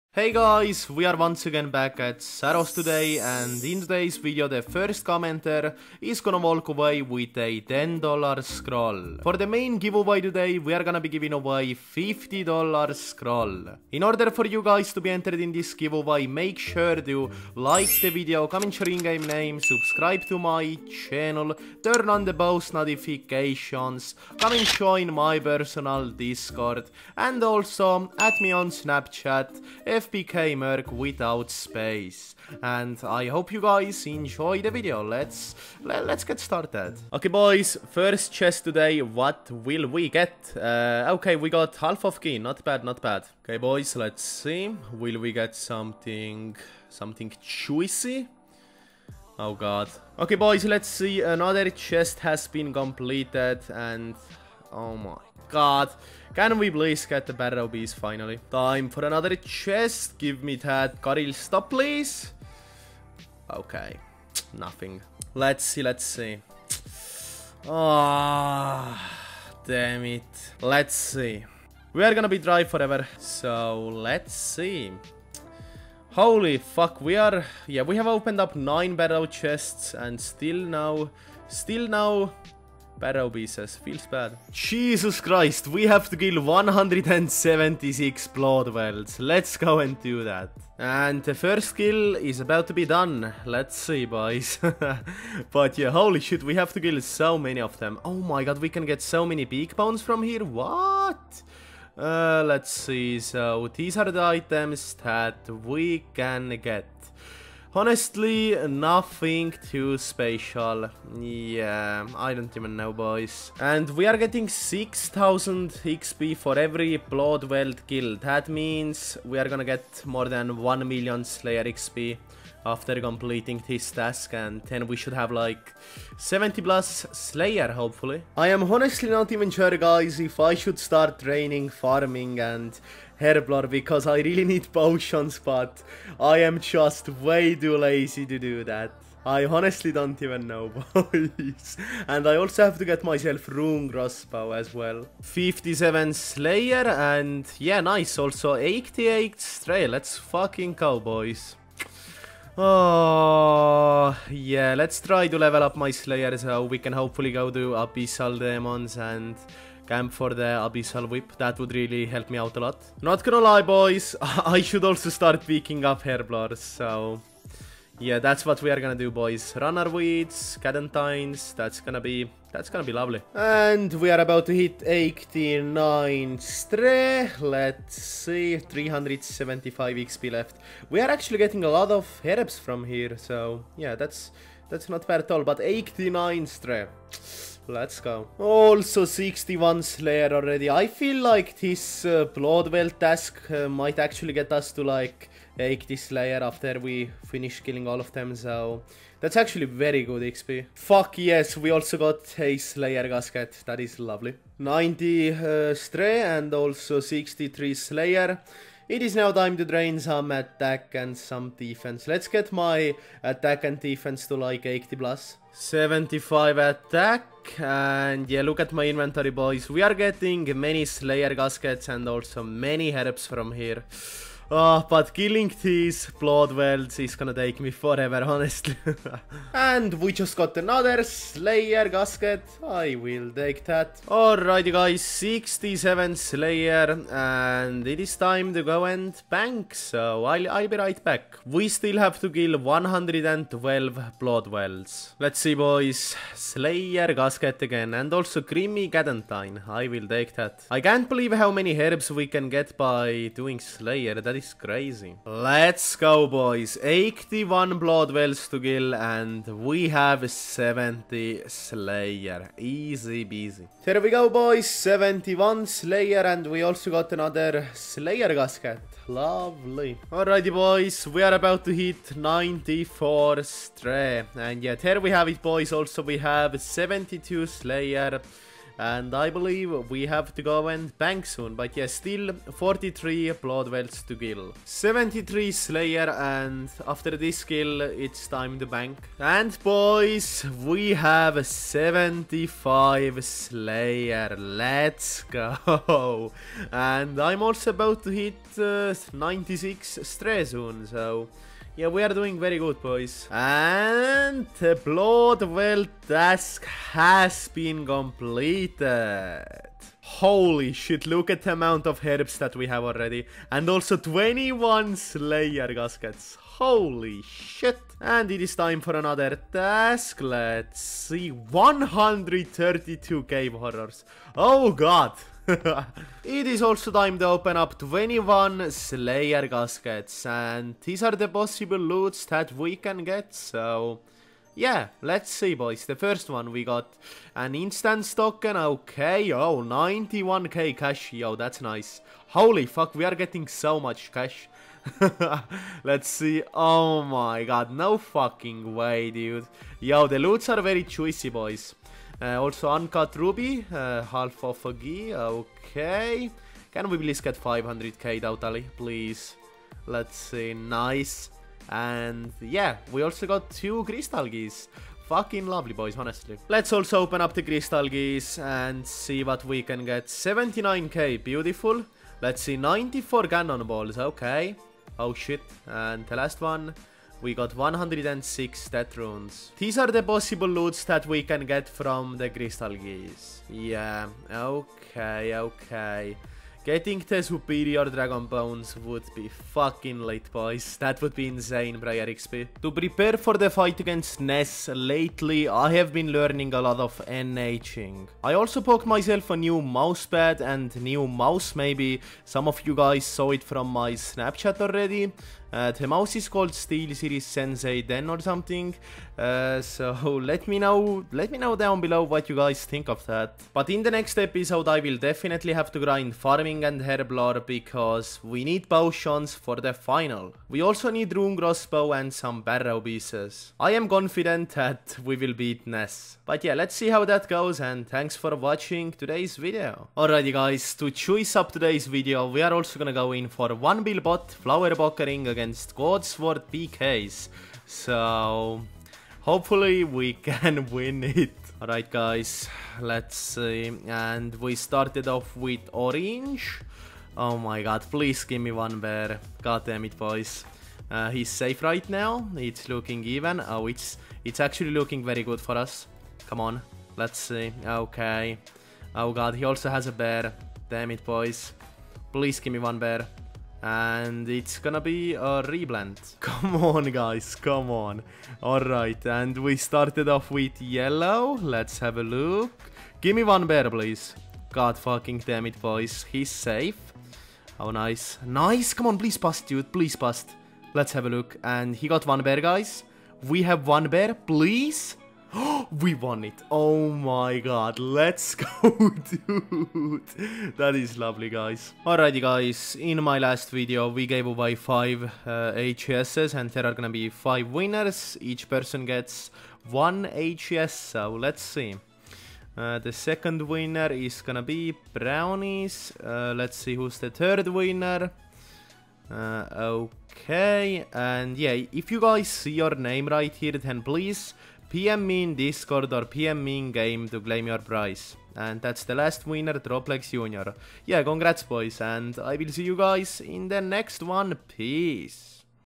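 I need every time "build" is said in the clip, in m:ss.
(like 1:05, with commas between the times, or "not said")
not said.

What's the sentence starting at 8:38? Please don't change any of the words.
And that's the last winner, Droplex Junior.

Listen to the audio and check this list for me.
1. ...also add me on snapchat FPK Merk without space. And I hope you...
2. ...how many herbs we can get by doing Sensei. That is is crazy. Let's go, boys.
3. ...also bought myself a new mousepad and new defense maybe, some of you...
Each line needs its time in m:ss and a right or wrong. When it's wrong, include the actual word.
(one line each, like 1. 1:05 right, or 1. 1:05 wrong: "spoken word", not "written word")
1. 0:27 right
2. 4:11 wrong: "Slayer", not "Sensei"
3. 6:38 wrong: "mouse", not "defense".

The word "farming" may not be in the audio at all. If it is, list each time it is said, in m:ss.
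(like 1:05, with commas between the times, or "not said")
2:11, 6:56.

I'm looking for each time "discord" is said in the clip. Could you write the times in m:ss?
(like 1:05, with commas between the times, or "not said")
0:26, 8:35.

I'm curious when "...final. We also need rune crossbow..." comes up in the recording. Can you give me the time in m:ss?
6:59.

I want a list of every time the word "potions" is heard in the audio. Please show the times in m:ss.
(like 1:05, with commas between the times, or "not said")
2:14, 6:58.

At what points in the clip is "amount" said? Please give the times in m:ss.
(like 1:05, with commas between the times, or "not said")
5:11.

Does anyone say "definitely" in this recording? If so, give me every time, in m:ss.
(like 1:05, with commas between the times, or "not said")
6:54.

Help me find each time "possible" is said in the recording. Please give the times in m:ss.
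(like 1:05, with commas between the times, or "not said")
5:31, 6:20.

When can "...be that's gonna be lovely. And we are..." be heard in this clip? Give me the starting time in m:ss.
2:52.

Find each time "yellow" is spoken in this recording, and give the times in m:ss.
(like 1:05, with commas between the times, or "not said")
7:50.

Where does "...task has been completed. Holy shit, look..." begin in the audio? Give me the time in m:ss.
5:06.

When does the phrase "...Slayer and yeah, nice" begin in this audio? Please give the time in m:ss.
2:26.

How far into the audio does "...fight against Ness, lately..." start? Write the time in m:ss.
6:33.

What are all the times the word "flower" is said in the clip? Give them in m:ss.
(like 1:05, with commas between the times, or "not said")
7:14.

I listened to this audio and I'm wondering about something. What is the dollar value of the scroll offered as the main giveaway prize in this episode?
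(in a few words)
$50.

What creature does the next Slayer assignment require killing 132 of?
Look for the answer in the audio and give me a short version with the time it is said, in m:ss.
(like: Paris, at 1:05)
cave horrors, at 5:23.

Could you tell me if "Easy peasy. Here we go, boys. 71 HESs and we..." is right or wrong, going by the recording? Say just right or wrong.
wrong.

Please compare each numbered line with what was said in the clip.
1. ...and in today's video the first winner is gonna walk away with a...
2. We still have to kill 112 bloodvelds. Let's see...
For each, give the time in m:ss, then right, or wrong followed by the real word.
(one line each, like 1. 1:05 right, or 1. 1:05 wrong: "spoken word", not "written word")
1. 0:03 wrong: "commenter", not "winner"
2. 4:01 right.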